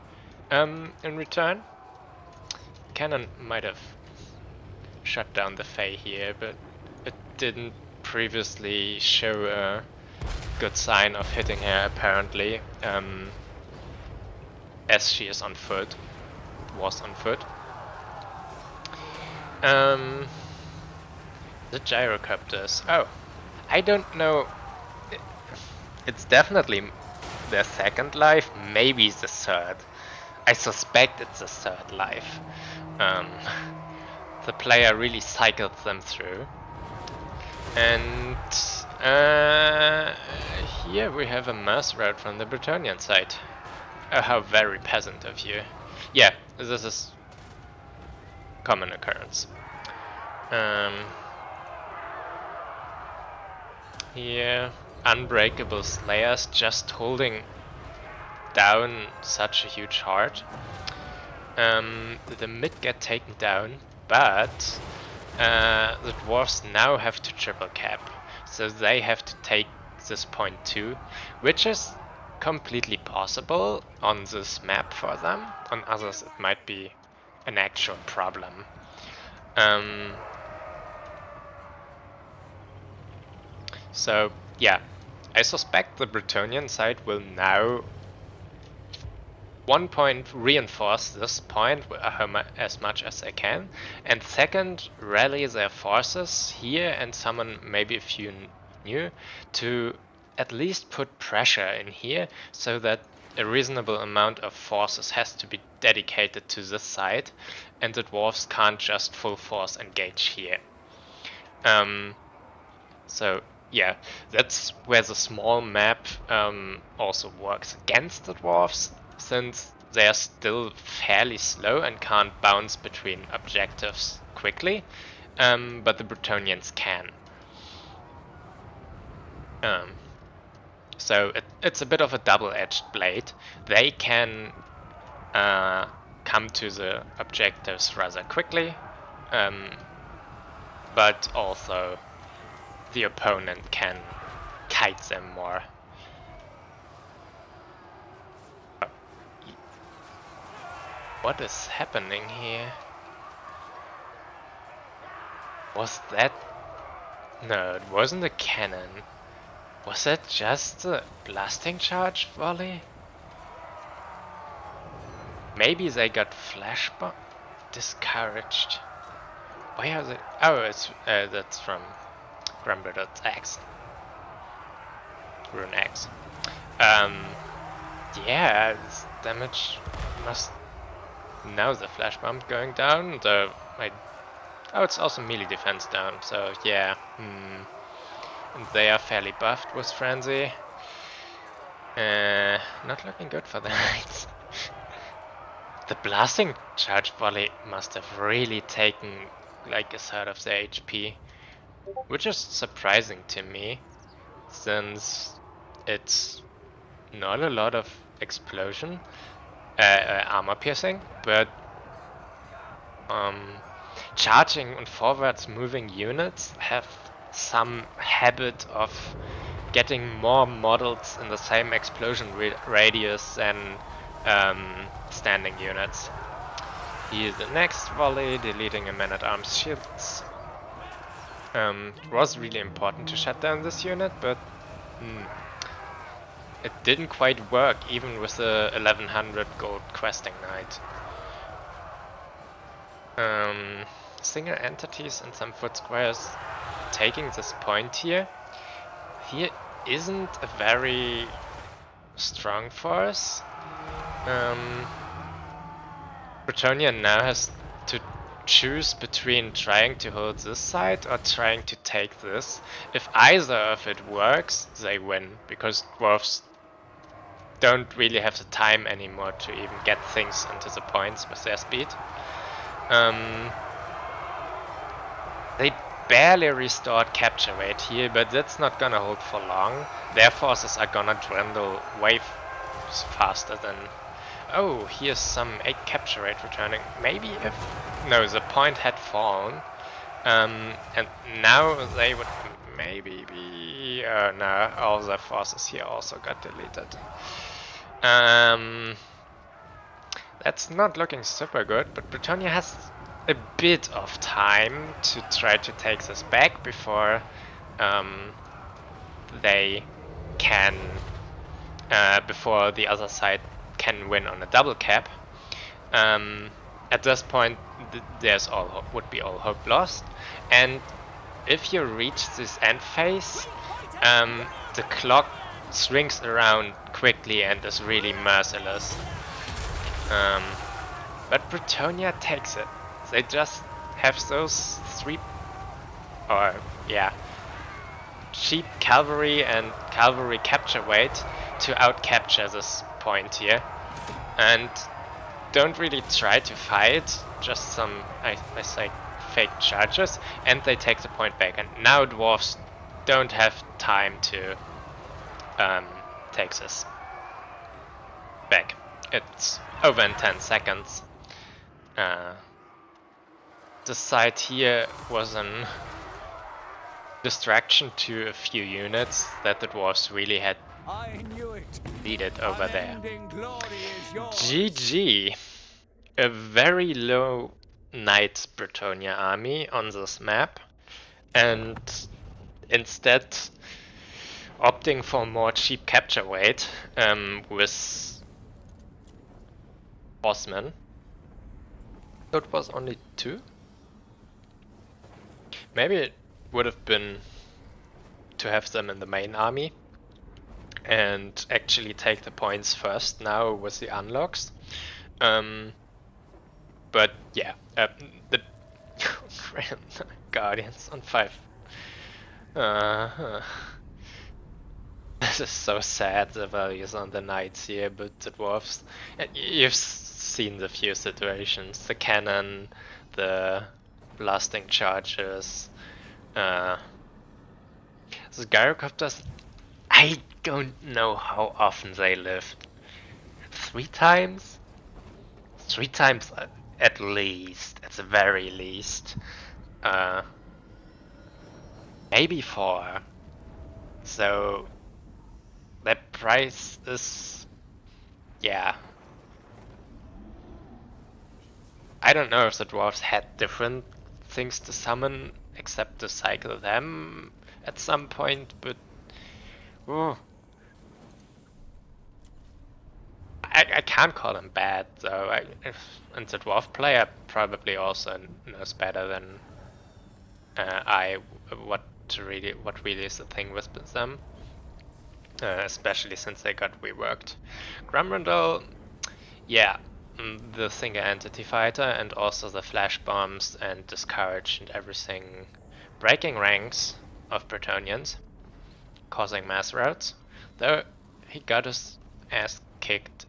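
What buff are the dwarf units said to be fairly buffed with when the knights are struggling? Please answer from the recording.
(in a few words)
Frenzy.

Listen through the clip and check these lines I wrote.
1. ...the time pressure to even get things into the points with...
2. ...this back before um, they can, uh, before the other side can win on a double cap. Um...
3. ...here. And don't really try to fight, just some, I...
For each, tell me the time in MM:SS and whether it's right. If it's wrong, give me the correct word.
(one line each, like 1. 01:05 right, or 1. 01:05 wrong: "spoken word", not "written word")
1. 04:28 wrong: "anymore", not "pressure"
2. 05:06 right
3. 05:43 right.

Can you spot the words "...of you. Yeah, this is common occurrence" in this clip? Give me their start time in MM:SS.
00:45.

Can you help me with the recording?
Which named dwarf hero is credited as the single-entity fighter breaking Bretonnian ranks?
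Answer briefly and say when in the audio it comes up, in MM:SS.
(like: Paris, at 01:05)
Grombrindal, at 07:57.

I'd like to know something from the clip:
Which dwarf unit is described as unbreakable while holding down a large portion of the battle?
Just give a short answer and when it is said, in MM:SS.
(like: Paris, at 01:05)
slayers, at 00:55.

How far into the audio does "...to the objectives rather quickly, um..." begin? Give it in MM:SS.
02:16.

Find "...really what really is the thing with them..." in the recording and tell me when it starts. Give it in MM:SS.
07:52.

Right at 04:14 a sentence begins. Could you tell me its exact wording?
Um, now has to choose between trying to hold this side or trying to take this.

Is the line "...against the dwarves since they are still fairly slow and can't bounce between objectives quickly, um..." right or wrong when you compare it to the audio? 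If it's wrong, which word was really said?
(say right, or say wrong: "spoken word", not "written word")
right.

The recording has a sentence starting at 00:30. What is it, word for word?
I suspect it's a third life.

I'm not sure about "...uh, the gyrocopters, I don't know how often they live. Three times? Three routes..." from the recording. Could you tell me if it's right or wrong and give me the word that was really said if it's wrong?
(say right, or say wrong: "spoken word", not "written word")
wrong: "times", not "routes".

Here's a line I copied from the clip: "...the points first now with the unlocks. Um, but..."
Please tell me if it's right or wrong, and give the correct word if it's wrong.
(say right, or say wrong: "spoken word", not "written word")
right.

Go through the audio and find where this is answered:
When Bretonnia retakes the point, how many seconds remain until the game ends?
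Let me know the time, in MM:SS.
06:00.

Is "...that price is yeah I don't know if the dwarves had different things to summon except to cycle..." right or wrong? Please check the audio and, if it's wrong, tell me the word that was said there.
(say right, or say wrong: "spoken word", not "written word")
right.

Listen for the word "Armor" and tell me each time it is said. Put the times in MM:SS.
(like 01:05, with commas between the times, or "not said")
03:30.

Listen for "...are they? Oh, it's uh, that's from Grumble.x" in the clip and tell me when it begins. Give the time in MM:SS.
02:49.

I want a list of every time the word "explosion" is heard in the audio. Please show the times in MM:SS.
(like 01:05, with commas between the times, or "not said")
03:28, 03:41.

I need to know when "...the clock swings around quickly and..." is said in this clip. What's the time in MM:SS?
05:24.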